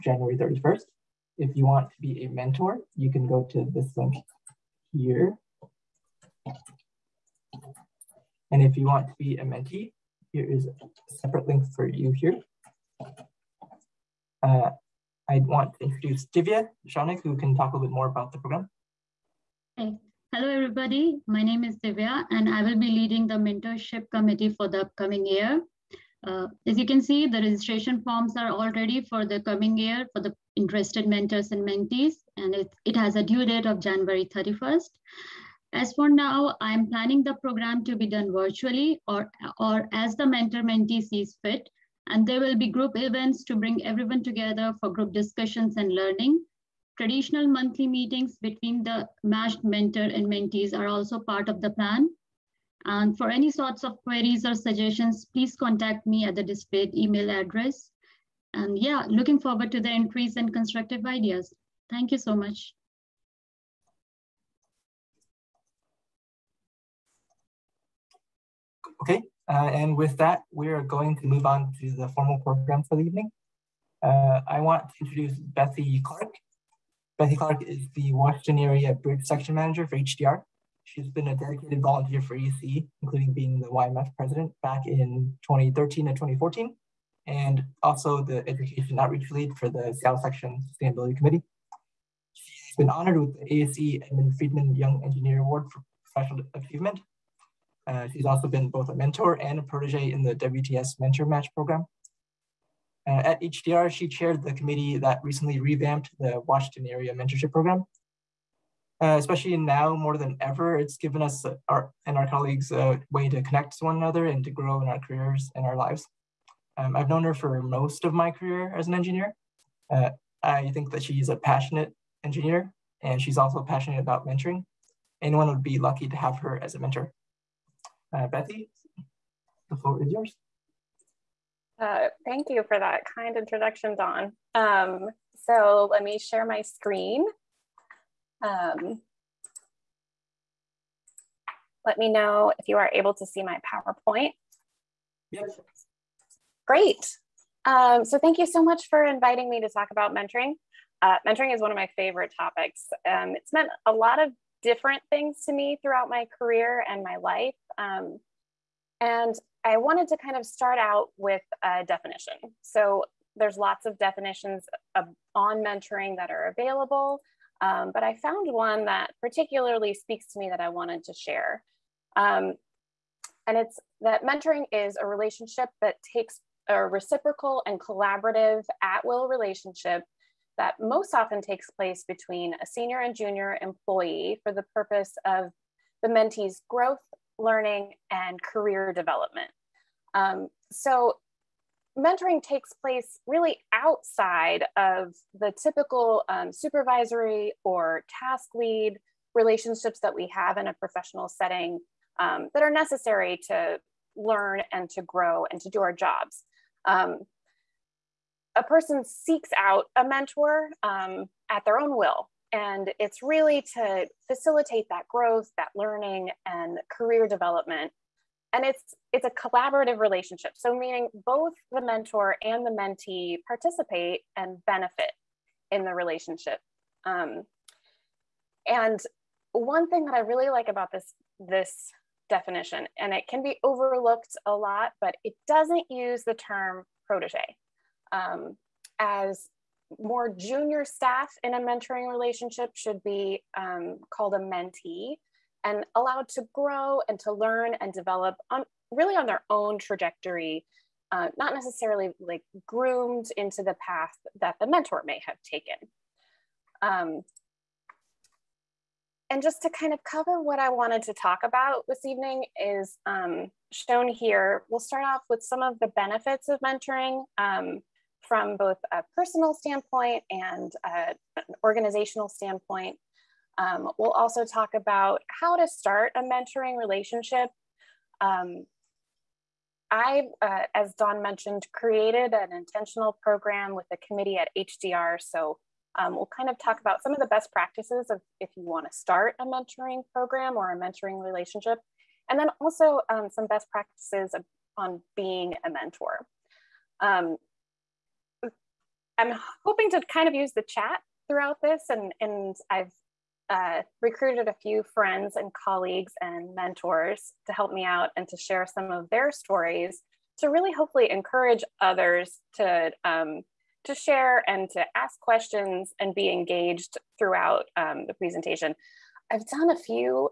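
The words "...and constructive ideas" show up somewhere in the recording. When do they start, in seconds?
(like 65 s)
60 s.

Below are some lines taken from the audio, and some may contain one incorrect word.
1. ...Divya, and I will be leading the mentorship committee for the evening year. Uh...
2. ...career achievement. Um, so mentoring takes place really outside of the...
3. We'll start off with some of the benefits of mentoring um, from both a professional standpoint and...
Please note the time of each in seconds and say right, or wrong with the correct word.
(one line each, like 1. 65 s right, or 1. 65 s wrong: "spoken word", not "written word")
1. 21 s wrong: "upcoming", not "evening"
2. 188 s wrong: "development", not "achievement"
3. 264 s wrong: "personal", not "professional".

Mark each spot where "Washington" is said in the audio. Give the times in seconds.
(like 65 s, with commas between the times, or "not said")
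78 s, 106 s.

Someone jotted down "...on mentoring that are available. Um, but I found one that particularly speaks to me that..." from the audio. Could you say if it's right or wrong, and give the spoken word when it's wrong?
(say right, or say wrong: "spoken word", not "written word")
right.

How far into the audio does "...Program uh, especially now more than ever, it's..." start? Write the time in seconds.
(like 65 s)
107 s.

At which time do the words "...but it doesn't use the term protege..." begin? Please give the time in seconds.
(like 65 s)
235 s.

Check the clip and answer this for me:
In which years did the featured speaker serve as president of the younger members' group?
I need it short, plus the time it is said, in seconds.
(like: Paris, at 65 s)
2013 and 2014, at 85 s.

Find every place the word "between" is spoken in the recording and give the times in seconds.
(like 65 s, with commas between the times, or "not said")
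48 s, 182 s.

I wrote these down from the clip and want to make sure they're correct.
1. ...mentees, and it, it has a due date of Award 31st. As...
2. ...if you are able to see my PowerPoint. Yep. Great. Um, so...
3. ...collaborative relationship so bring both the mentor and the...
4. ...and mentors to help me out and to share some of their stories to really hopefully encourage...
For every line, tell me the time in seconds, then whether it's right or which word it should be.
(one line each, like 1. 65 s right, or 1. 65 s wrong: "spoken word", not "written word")
1. 31 s wrong: "January", not "Award"
2. 142 s right
3. 219 s wrong: "meaning", not "bring"
4. 306 s right.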